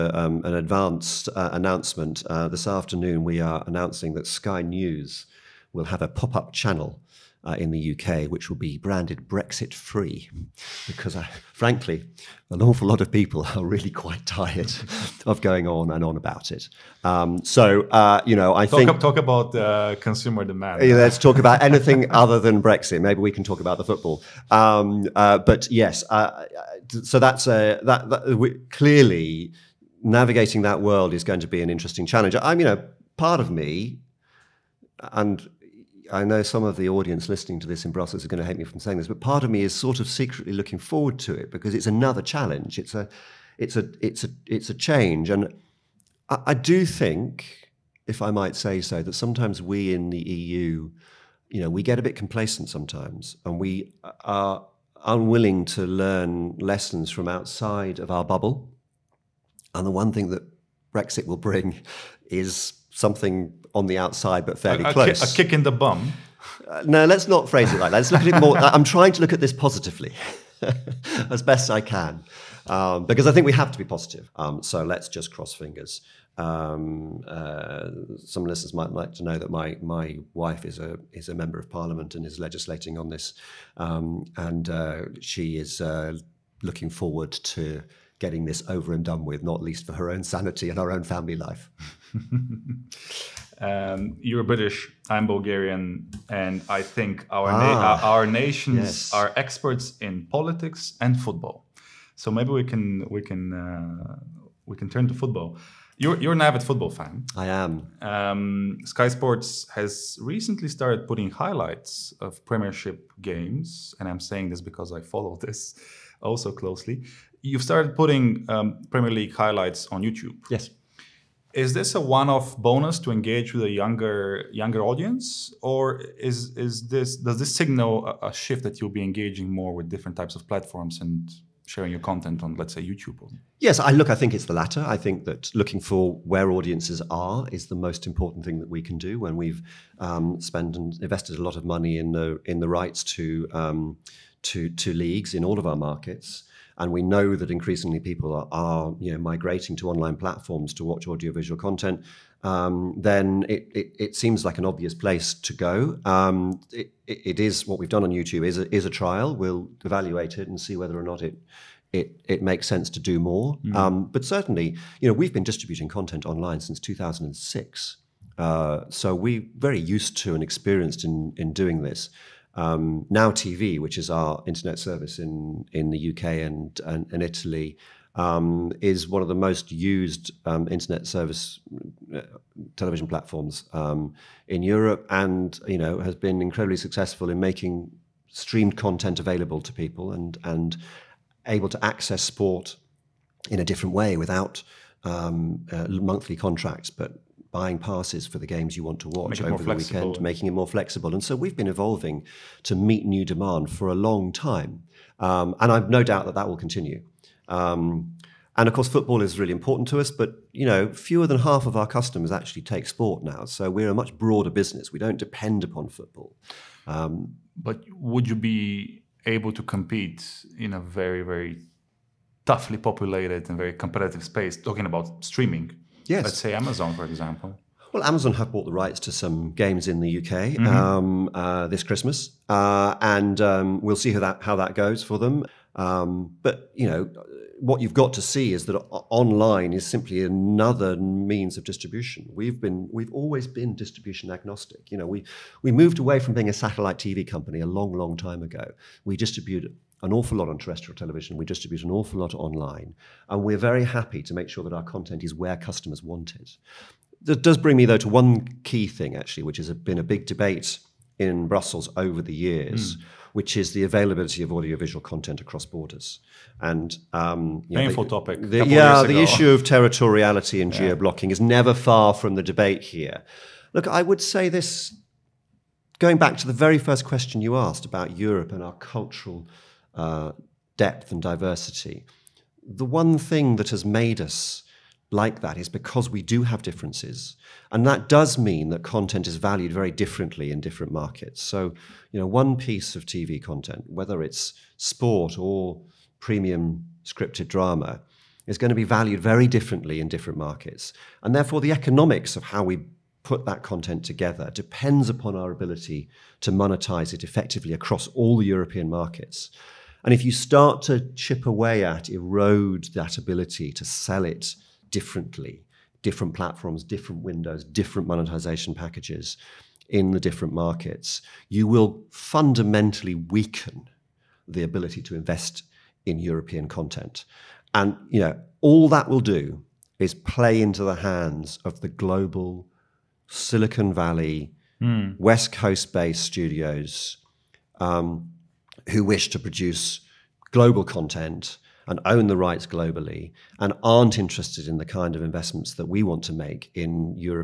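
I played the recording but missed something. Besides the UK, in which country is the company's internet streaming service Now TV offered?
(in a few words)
Italy.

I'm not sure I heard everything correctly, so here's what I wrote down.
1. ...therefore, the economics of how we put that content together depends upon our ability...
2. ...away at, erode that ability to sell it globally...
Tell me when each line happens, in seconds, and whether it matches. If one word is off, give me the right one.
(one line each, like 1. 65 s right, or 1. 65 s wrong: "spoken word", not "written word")
1. 301 s right
2. 311 s wrong: "differently", not "globally".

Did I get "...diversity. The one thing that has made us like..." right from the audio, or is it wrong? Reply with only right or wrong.
right.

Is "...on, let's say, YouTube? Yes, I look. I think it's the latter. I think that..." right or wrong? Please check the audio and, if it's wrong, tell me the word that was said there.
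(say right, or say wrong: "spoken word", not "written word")
right.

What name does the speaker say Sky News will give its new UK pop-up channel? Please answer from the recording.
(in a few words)
Brexit free.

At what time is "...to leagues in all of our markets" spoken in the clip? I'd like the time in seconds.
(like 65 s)
144 s.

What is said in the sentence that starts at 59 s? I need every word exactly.
And the one thing that Brexit will bring is something on the outside, but fairly a, a close.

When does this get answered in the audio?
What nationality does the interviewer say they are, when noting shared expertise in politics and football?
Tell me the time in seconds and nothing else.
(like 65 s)
95 s.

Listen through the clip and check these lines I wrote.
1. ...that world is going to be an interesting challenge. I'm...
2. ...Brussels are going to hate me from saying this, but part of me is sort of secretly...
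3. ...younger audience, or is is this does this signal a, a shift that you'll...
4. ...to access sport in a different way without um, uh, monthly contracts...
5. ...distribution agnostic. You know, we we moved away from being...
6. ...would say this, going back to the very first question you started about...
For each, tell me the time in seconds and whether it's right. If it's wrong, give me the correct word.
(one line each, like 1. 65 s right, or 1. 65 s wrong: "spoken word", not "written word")
1. 30 s right
2. 37 s right
3. 124 s right
4. 191 s right
5. 243 s right
6. 274 s wrong: "asked", not "started".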